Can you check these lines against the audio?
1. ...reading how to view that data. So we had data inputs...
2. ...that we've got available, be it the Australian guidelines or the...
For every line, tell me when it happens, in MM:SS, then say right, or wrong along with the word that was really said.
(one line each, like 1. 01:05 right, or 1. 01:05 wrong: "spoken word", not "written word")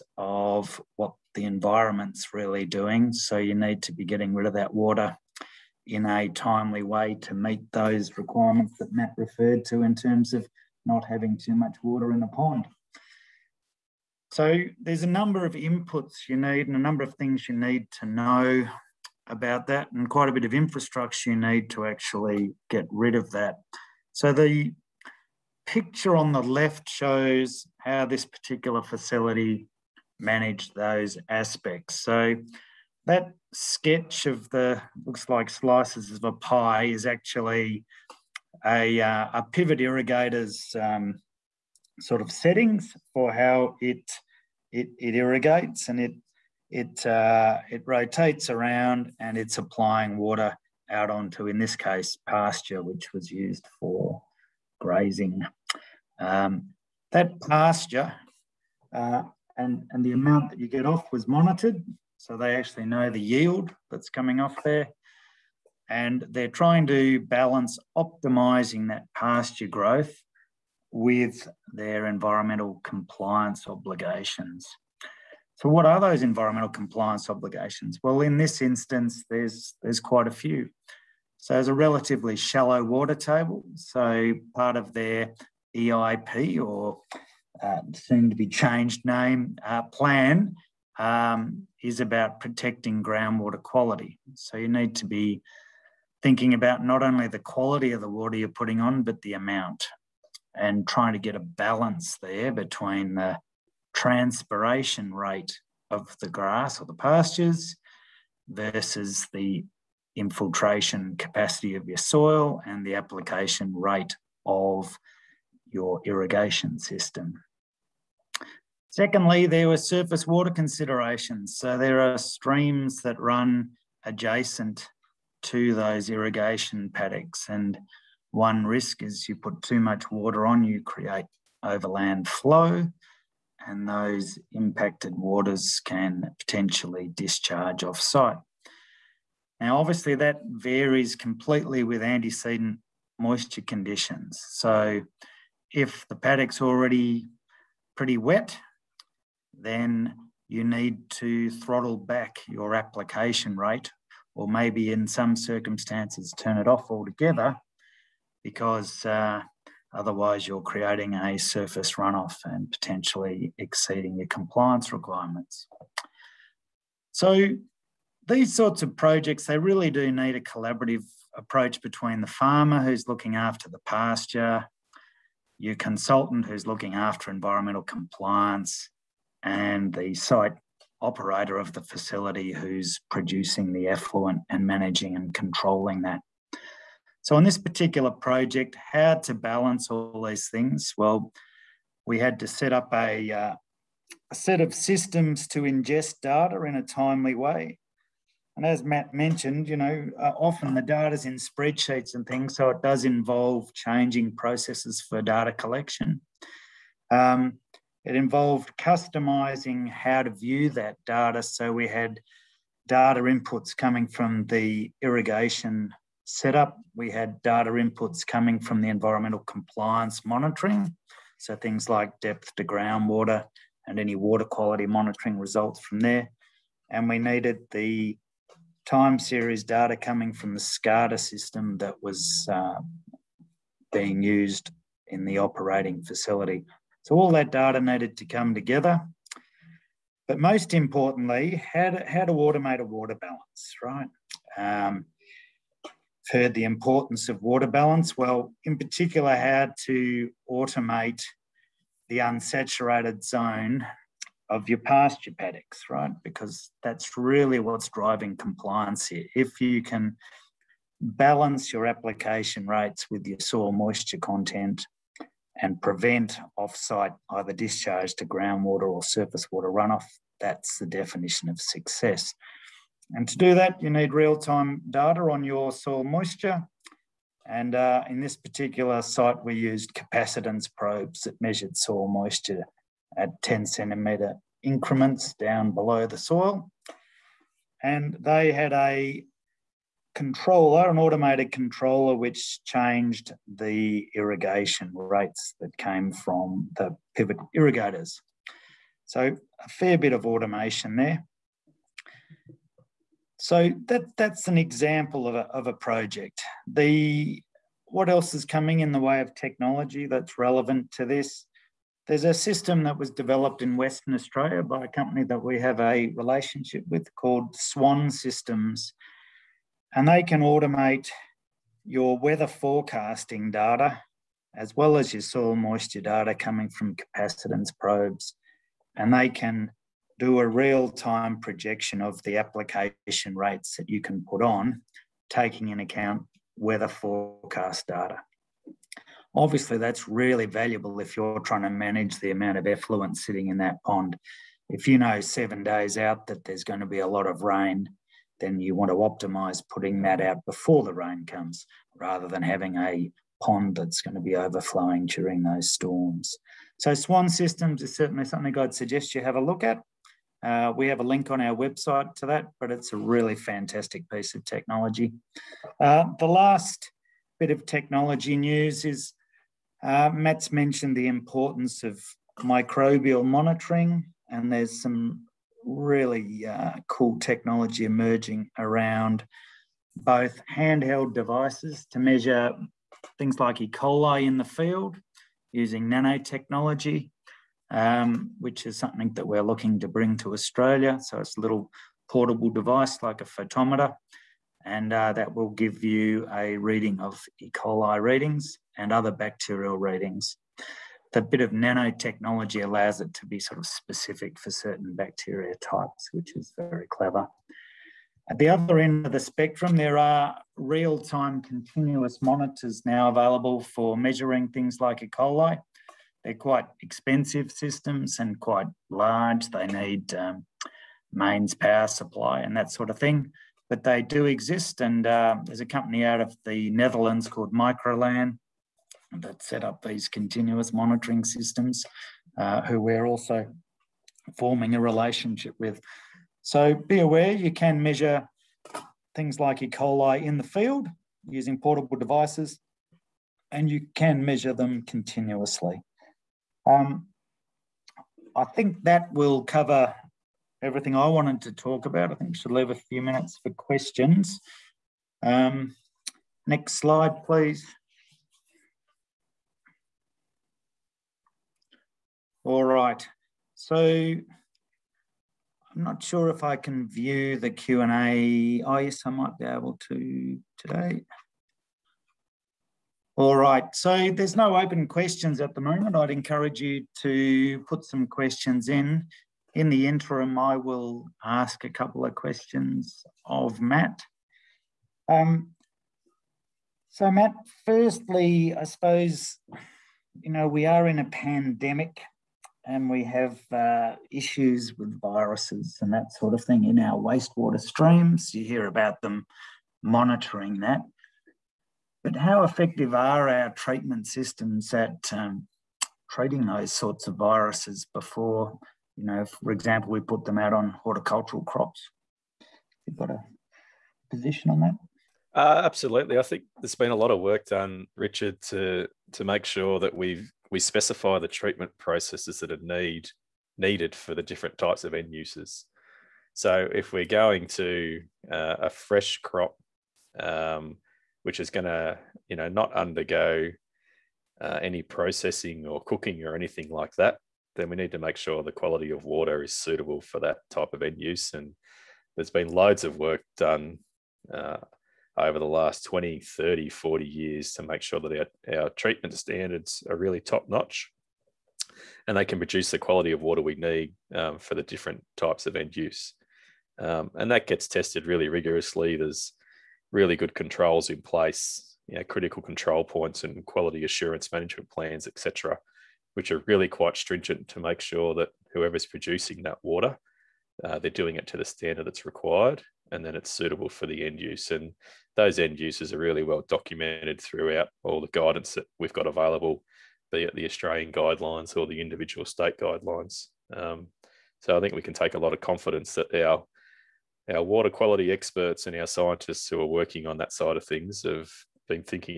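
1. 03:28 wrong: "customizing", not "reading"
2. 09:38 right.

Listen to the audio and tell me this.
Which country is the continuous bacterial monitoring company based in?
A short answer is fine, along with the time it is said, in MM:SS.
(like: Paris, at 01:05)
Netherlands, at 07:06.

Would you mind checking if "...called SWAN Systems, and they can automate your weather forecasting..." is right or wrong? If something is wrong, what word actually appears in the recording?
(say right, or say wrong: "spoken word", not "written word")
right.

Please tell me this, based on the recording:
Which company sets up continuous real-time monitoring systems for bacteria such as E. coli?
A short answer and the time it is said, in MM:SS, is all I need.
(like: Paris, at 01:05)
Microlan, at 07:07.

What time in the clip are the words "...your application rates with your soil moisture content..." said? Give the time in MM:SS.
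04:21.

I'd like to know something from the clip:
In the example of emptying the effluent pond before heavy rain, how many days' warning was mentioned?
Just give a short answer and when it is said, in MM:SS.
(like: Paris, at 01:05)
7, at 05:45.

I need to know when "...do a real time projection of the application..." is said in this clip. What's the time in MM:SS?
05:30.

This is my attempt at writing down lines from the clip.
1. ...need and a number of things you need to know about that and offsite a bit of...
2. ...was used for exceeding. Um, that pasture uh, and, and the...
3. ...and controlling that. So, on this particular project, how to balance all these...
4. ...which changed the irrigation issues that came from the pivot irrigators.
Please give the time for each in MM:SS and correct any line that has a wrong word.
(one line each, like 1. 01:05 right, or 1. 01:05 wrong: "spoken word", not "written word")
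1. 00:16 wrong: "quite", not "offsite"
2. 00:53 wrong: "grazing", not "exceeding"
3. 03:05 right
4. 04:52 wrong: "rates", not "issues".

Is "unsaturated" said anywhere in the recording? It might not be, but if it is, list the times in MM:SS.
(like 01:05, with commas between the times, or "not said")
04:12.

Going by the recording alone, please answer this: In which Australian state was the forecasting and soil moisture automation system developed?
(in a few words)
Western Australia.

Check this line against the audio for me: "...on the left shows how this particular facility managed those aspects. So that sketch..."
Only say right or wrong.
right.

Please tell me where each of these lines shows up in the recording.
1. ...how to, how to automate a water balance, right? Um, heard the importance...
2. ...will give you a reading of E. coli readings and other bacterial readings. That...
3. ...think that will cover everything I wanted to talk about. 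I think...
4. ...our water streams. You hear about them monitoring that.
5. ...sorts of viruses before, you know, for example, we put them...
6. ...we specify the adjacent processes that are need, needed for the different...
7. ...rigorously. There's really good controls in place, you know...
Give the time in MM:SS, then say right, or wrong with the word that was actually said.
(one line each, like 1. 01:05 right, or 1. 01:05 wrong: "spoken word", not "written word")
1. 04:01 right
2. 06:35 right
3. 07:28 right
4. 08:16 wrong: "wastewater", not "water"
5. 08:26 right
6. 08:40 wrong: "treatment", not "adjacent"
7. 09:18 right.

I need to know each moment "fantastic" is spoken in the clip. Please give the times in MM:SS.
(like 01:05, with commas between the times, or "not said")
06:03.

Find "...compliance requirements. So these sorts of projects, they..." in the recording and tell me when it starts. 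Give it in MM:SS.
02:44.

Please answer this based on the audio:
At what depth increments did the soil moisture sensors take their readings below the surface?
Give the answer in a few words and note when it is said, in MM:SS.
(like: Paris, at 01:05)
10 centimetres, at 04:43.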